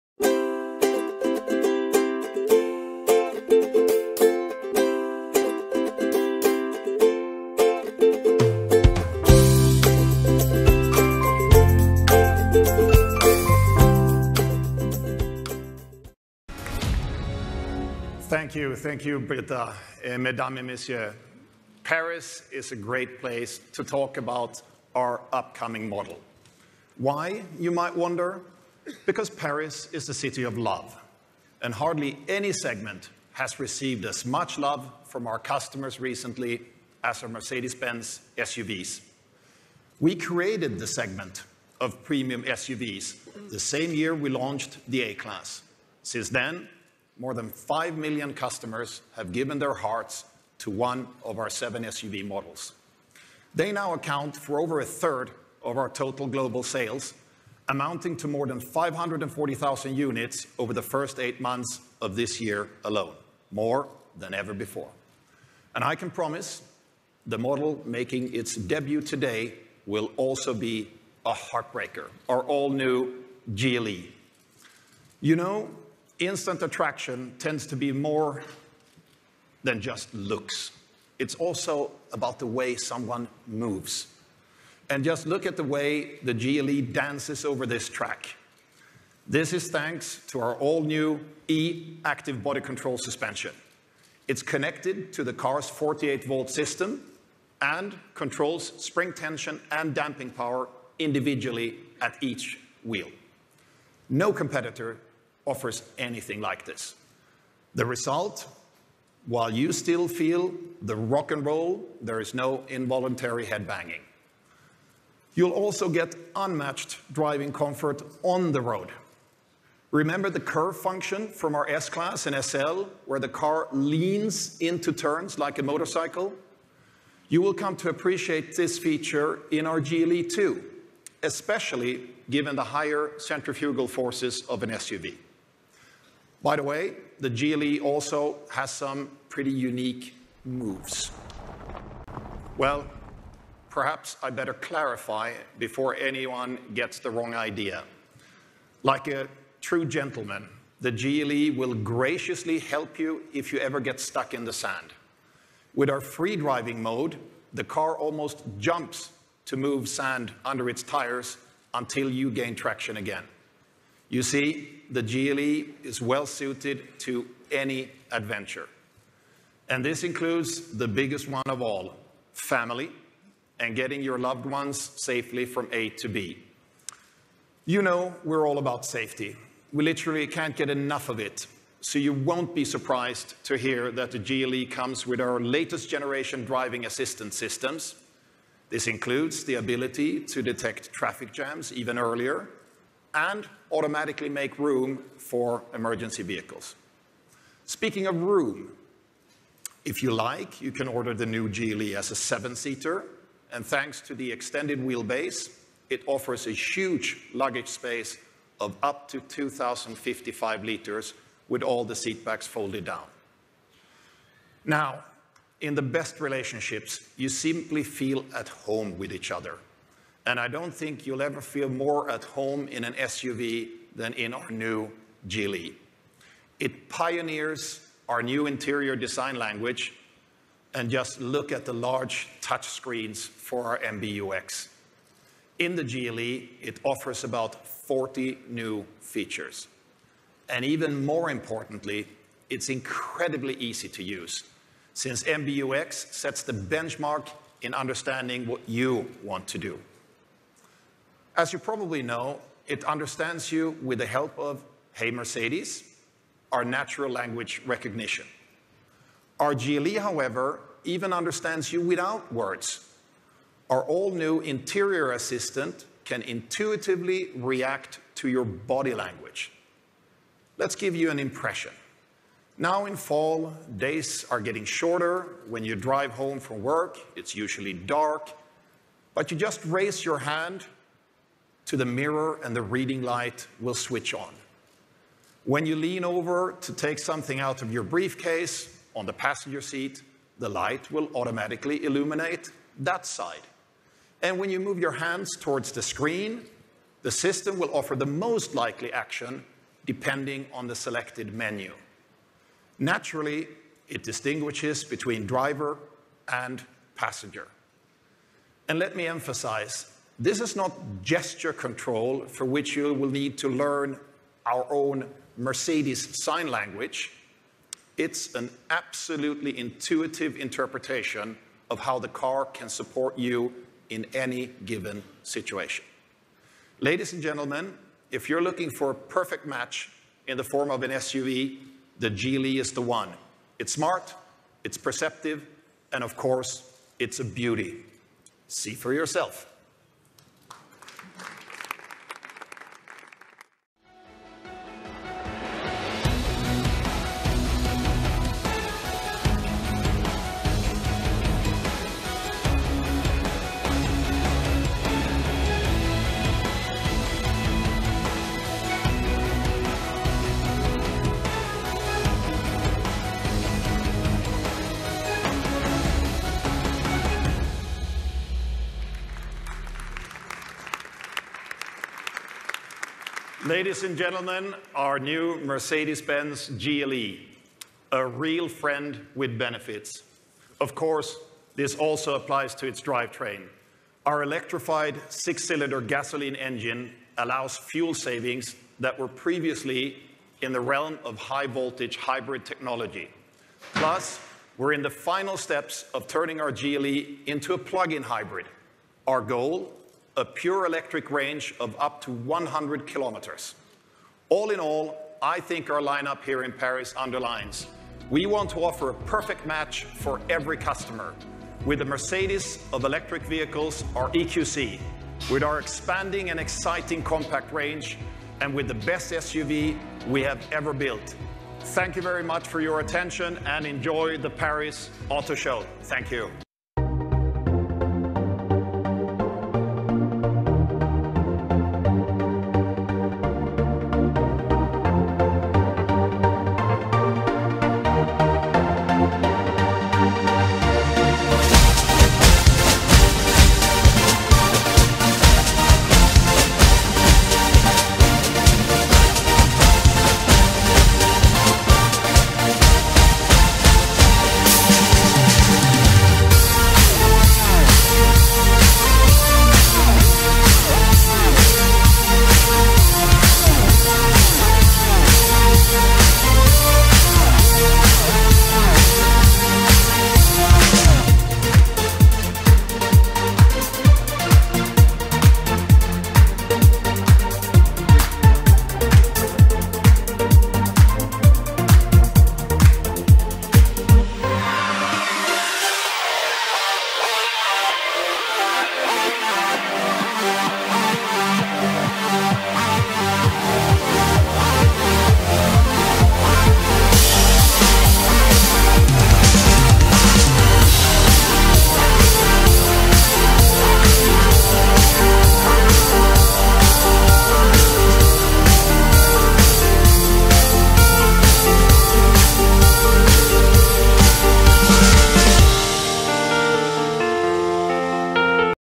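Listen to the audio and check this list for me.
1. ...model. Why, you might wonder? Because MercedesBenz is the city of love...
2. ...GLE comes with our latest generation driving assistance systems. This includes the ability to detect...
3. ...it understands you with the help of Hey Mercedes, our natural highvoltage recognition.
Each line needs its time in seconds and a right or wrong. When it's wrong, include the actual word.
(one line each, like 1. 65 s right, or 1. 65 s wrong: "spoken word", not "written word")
1. 25 s wrong: "Paris", not "MercedesBenz"
2. 184 s right
3. 252 s wrong: "language", not "highvoltage".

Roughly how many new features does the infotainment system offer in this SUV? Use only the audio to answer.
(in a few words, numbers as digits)
about 40.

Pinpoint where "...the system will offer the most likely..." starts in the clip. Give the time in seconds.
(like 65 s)
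297 s.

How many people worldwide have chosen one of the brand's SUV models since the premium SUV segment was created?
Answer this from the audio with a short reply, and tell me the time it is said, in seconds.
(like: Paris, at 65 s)
more than 5 million, at 47 s.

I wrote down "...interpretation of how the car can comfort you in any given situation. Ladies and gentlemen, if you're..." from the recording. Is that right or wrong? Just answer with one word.
wrong.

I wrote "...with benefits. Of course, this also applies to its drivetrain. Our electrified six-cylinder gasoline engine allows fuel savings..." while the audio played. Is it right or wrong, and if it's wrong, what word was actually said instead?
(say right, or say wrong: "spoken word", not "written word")
right.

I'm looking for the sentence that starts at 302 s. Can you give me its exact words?
Naturally, it distinguishes between driver and passenger.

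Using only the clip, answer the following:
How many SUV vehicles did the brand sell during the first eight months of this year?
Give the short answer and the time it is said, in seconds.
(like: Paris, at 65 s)
more than 540,000, at 58 s.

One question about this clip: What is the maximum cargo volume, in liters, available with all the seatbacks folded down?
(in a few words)
2,055 liters.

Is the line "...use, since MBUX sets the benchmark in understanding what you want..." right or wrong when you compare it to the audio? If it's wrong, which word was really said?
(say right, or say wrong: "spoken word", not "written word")
right.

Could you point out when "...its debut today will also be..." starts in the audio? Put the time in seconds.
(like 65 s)
68 s.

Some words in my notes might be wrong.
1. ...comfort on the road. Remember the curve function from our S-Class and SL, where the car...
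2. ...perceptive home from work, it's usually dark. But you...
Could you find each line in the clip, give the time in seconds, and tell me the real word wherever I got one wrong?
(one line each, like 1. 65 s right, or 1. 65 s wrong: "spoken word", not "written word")
1. 117 s right
2. 275 s wrong: "drive", not "perceptive".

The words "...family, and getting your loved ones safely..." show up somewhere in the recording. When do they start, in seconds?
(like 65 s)
172 s.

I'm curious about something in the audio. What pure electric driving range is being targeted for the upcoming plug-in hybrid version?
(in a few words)
up to 100 kilometers.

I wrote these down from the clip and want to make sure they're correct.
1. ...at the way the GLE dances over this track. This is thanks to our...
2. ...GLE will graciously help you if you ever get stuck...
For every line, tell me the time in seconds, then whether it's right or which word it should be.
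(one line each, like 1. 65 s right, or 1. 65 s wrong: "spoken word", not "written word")
1. 85 s right
2. 150 s right.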